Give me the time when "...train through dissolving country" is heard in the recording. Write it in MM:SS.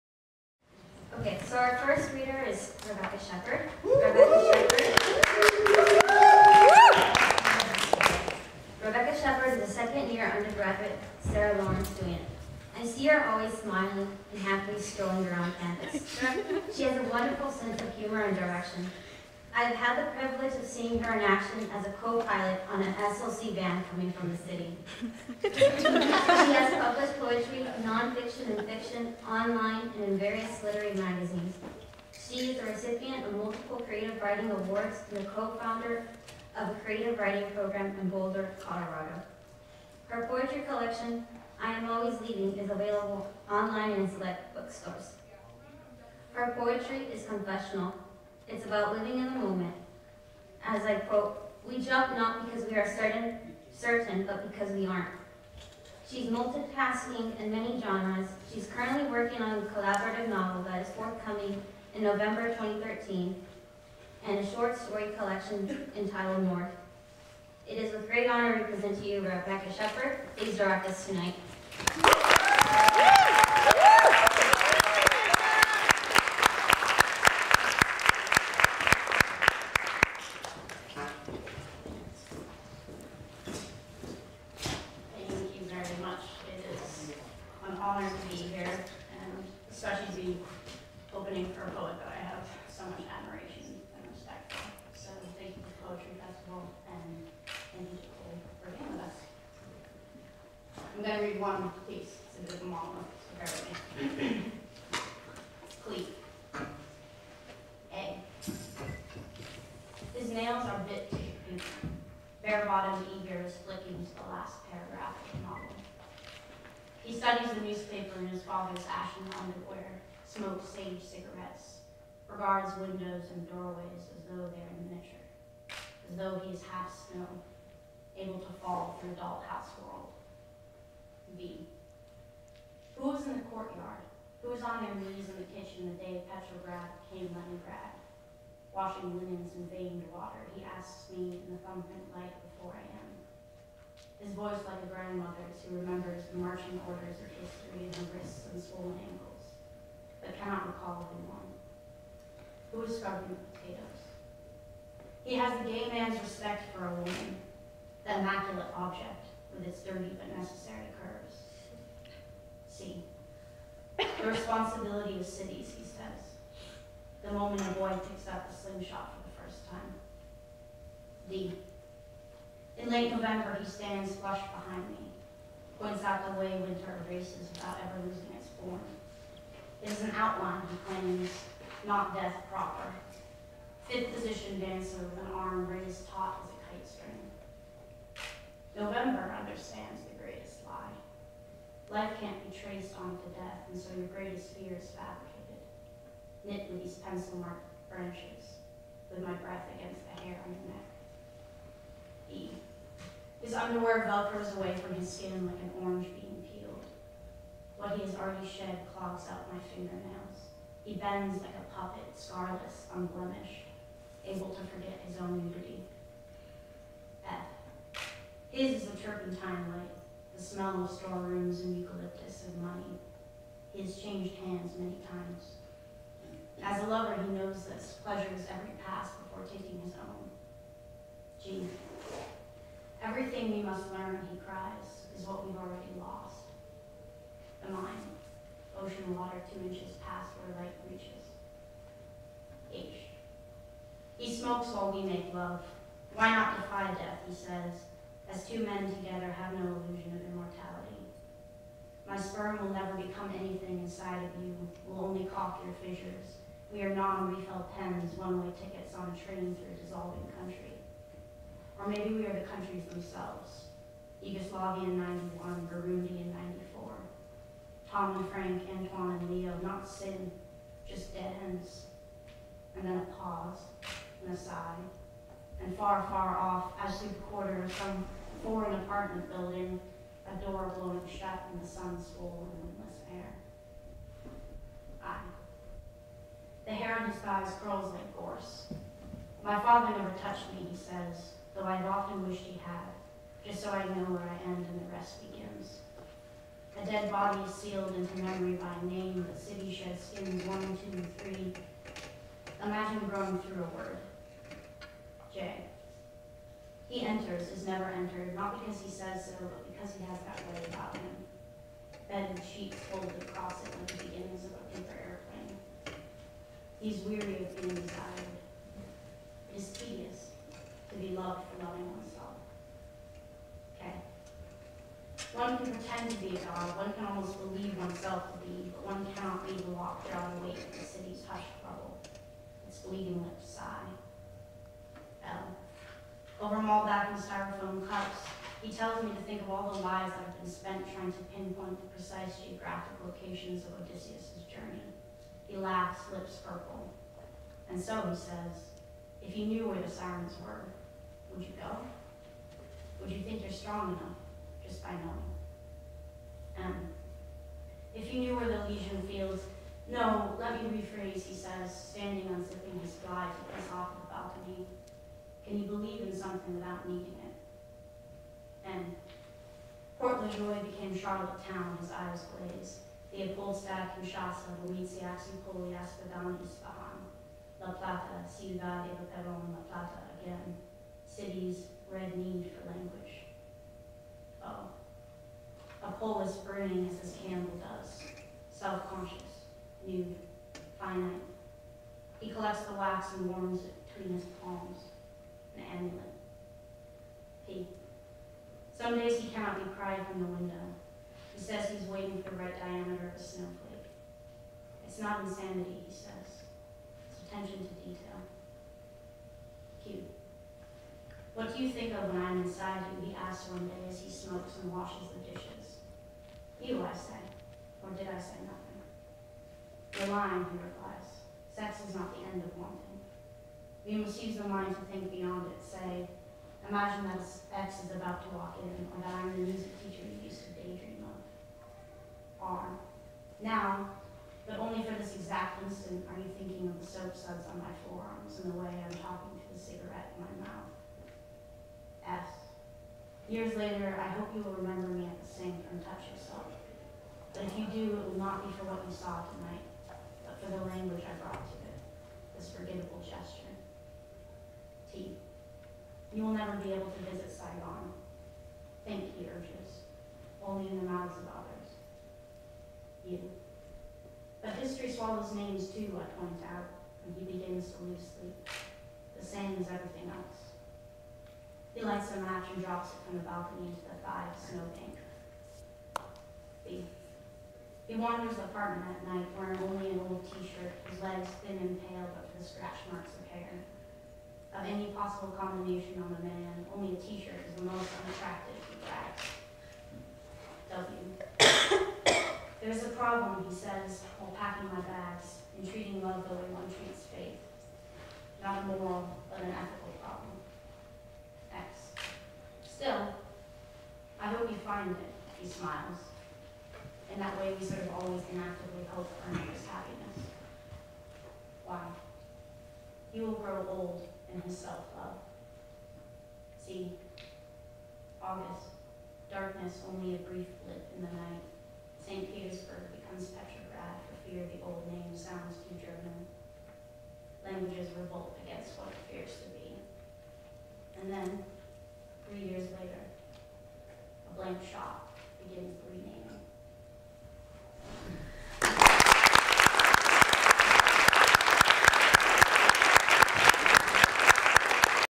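04:19.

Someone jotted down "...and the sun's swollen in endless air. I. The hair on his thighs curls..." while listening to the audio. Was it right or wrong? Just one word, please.
right.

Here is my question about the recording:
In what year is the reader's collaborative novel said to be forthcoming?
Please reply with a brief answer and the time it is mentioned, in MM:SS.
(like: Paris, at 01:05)
2013, at 01:02.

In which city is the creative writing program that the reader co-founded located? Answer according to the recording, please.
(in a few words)
Boulder, Colorado.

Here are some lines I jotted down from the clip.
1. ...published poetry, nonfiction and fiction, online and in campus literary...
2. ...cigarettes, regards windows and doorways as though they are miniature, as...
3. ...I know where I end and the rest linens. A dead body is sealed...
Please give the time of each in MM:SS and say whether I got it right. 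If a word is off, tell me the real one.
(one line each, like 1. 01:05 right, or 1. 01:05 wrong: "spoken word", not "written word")
1. 00:26 wrong: "various", not "campus"
2. 02:01 right
3. 04:53 wrong: "begins", not "linens".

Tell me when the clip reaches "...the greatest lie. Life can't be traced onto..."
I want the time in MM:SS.
03:10.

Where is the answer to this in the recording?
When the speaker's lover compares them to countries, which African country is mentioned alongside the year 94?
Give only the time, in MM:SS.
04:25.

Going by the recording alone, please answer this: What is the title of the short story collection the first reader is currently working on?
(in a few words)
North.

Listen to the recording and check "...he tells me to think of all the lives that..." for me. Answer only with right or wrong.
right.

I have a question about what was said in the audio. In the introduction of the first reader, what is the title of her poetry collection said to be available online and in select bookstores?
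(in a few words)
I Am Always Leaving.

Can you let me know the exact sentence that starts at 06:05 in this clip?
Can you believe in something without needing it?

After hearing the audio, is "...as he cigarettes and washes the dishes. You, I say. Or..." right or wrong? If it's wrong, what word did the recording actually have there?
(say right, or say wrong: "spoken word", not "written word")
wrong: "smokes", not "cigarettes".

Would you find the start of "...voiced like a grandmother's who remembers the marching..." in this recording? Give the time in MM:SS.
02:24.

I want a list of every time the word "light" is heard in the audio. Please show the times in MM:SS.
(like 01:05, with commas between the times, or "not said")
02:22, 03:39, 04:00, 07:51.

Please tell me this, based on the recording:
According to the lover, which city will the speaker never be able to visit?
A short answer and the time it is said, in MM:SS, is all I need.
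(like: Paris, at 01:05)
Saigon, at 07:37.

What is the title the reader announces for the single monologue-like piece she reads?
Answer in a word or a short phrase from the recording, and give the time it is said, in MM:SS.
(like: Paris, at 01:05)
Cleat, at 01:45.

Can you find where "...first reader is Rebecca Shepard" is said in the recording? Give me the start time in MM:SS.
00:01.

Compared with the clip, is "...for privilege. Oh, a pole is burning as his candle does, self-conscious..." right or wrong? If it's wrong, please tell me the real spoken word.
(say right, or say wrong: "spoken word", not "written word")
wrong: "language", not "privilege".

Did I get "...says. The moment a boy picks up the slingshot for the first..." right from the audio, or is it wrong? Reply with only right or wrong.
right.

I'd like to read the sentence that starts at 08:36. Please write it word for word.
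See, August, darkness only a brief blip in the night.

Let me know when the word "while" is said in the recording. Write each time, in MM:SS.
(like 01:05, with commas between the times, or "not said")
04:04, 08:14.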